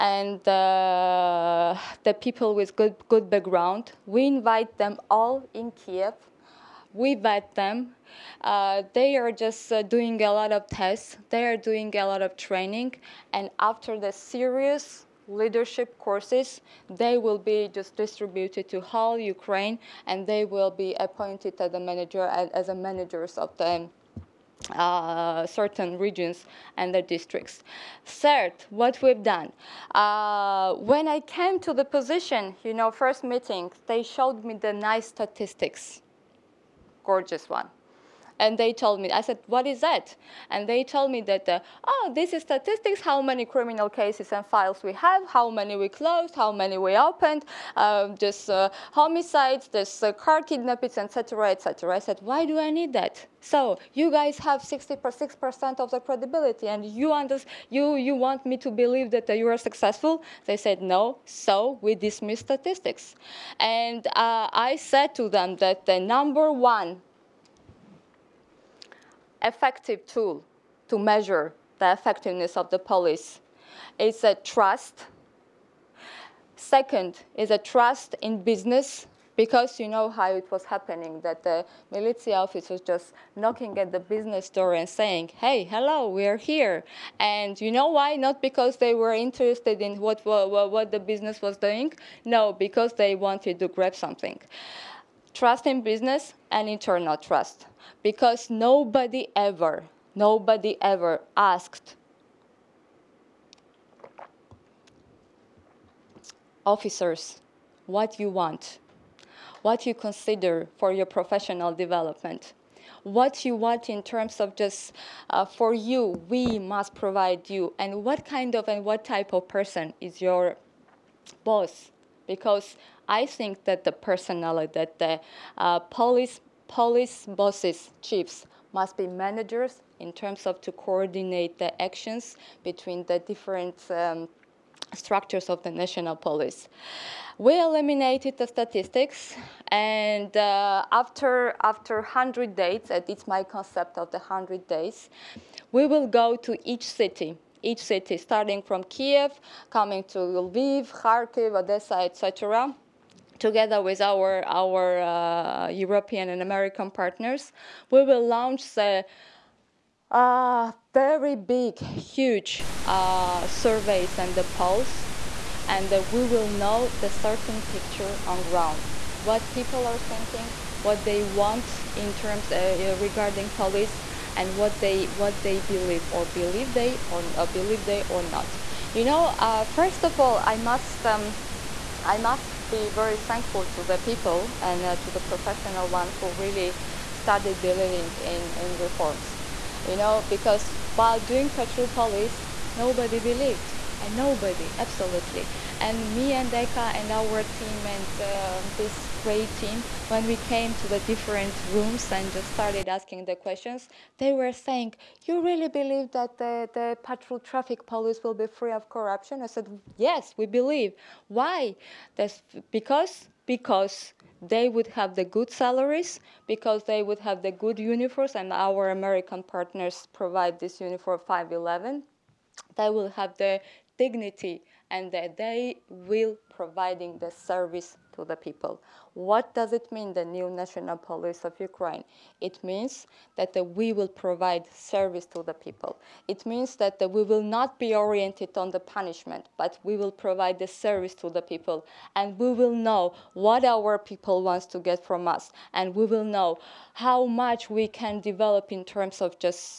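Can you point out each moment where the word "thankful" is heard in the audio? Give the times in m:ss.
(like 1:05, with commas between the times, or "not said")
3:03.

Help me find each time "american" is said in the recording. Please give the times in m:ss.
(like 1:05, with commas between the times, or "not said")
2:36, 3:38.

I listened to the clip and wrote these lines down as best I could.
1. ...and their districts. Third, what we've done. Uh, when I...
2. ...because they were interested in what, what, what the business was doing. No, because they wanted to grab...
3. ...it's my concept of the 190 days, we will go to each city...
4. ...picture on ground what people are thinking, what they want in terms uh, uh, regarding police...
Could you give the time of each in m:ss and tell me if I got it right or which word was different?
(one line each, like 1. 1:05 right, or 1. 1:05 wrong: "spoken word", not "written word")
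1. 0:26 right
2. 1:28 right
3. 2:23 wrong: "100", not "190"
4. 2:47 right.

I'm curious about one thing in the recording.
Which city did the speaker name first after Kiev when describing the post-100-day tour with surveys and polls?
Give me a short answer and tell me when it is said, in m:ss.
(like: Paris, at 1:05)
Lviv, at 2:30.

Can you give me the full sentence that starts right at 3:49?
What does it mean, the new national police of Ukraine?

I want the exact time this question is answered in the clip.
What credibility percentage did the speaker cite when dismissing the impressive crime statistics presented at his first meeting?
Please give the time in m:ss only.
0:54.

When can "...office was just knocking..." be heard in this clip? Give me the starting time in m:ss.
1:22.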